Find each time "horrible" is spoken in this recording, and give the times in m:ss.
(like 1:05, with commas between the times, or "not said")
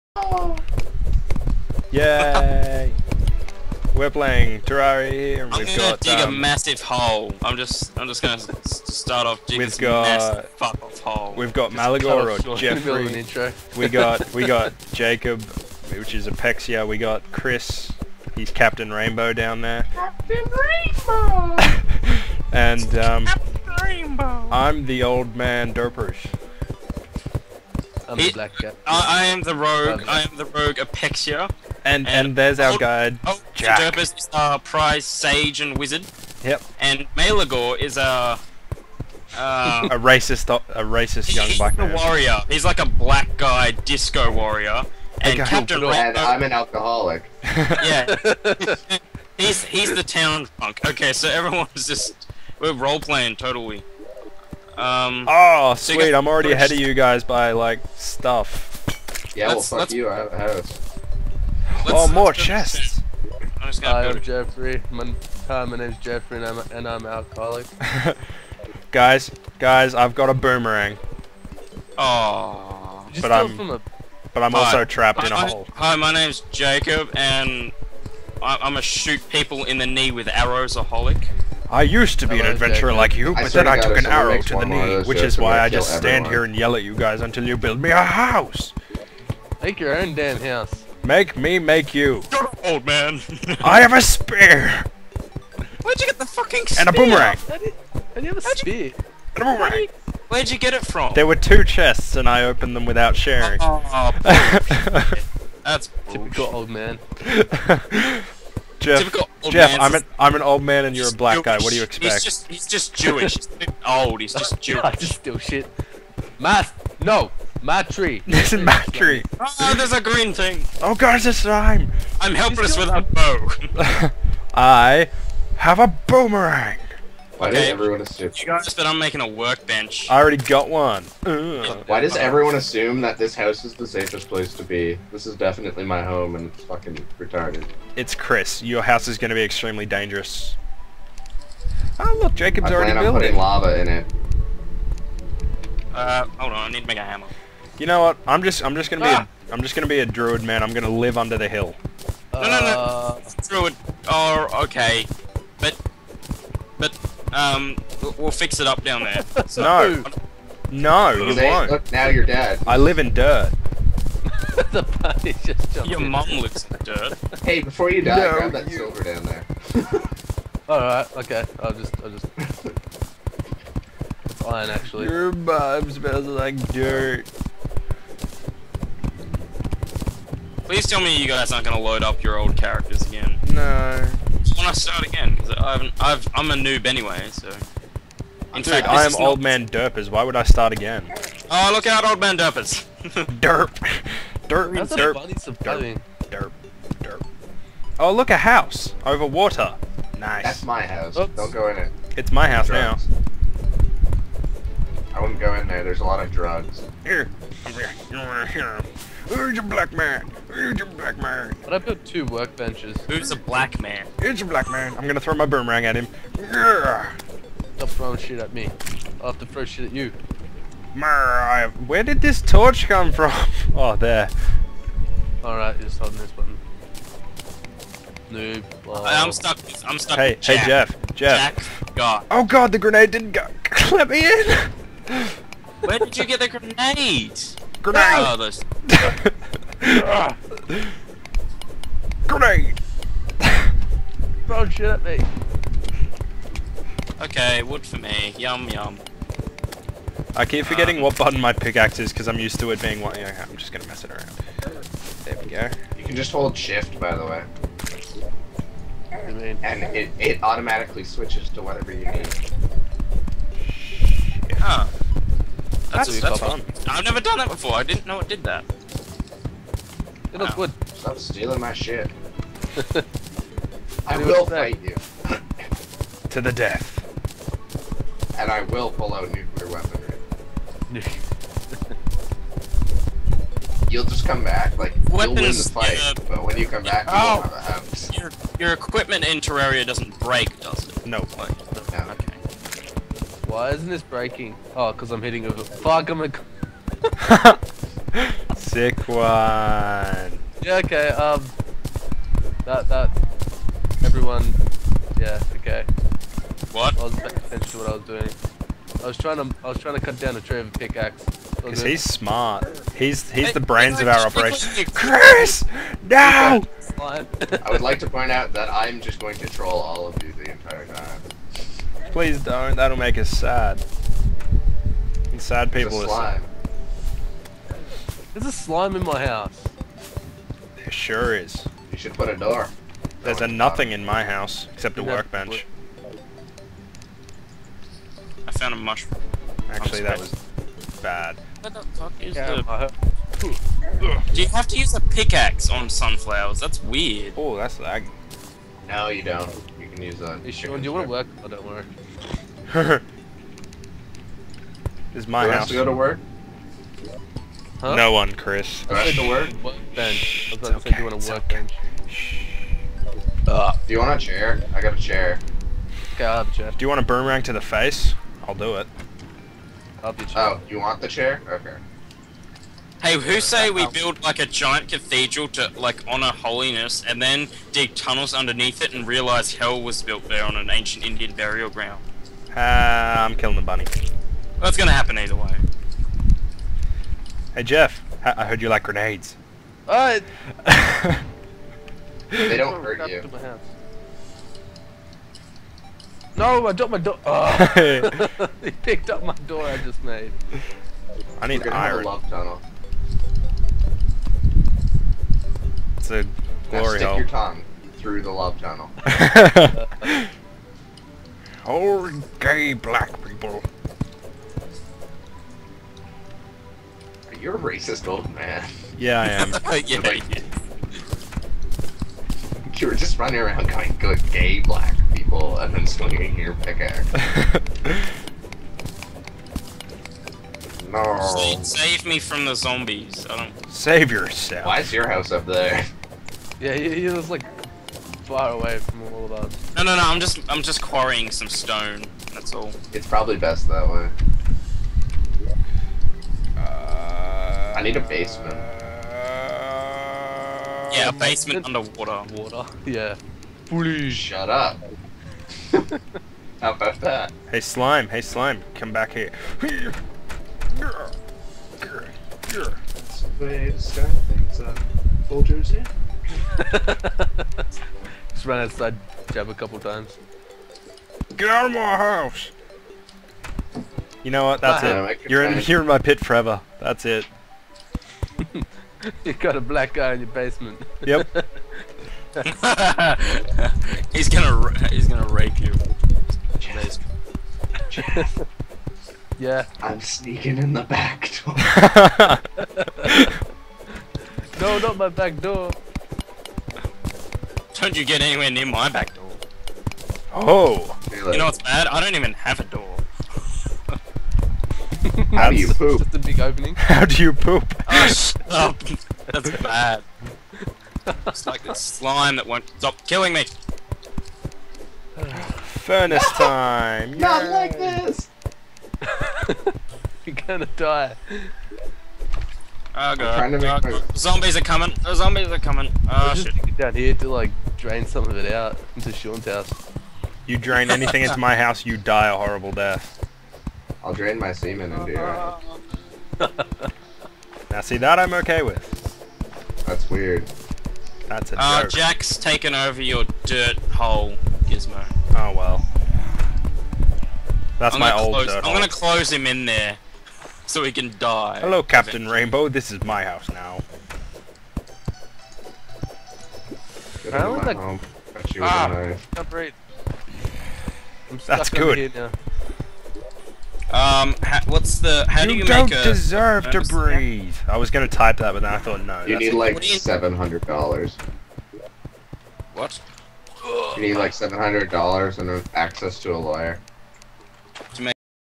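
8:52.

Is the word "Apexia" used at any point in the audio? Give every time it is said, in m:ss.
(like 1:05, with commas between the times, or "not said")
0:16, 0:30.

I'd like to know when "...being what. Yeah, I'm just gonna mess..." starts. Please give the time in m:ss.
4:12.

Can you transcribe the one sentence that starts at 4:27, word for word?
I didn't know it did that.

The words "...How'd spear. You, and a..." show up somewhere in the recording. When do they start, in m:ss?
1:38.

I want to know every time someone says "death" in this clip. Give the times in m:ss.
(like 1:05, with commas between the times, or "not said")
4:36, 8:52.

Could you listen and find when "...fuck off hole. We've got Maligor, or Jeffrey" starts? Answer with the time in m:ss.
0:10.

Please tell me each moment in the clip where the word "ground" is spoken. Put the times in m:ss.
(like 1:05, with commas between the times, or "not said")
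6:21.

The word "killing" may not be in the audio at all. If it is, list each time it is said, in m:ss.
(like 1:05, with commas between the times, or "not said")
6:23, 8:33.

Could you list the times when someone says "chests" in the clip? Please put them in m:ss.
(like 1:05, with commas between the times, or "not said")
1:02, 1:41.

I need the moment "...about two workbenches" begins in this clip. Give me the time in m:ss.
3:31.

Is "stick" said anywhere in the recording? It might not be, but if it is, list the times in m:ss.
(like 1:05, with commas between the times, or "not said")
6:46.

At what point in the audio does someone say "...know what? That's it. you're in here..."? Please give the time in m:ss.
7:54.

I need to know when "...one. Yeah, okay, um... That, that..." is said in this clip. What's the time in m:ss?
4:59.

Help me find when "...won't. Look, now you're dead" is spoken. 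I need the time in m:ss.
2:41.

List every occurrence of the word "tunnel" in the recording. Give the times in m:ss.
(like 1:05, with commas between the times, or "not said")
6:17, 6:42, 6:48.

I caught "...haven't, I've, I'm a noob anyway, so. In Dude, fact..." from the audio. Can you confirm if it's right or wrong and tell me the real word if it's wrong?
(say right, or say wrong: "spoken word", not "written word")
right.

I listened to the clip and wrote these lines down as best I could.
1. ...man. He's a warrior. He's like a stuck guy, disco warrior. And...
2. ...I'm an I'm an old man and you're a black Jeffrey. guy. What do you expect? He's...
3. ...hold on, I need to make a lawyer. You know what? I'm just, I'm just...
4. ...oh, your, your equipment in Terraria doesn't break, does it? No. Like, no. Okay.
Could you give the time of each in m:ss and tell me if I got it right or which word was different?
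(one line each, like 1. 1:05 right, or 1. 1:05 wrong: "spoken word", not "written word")
1. 0:41 wrong: "black", not "stuck"
2. 1:49 wrong: "Jewish", not "Jeffrey"
3. 2:26 wrong: "hammer", not "lawyer"
4. 4:47 right.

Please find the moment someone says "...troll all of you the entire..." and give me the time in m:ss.
5:19.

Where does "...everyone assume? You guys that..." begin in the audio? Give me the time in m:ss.
2:07.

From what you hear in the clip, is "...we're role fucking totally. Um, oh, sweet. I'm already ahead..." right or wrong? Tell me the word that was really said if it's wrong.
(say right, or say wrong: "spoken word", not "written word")
wrong: "playing", not "fucking".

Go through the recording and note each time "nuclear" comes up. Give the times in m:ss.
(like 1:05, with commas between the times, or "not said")
4:39.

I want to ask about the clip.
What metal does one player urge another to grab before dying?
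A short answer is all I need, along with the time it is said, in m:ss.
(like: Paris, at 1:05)
Silver, at 2:48.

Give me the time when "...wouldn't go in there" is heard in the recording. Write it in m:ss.
3:25.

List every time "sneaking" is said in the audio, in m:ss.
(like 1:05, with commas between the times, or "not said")
8:10.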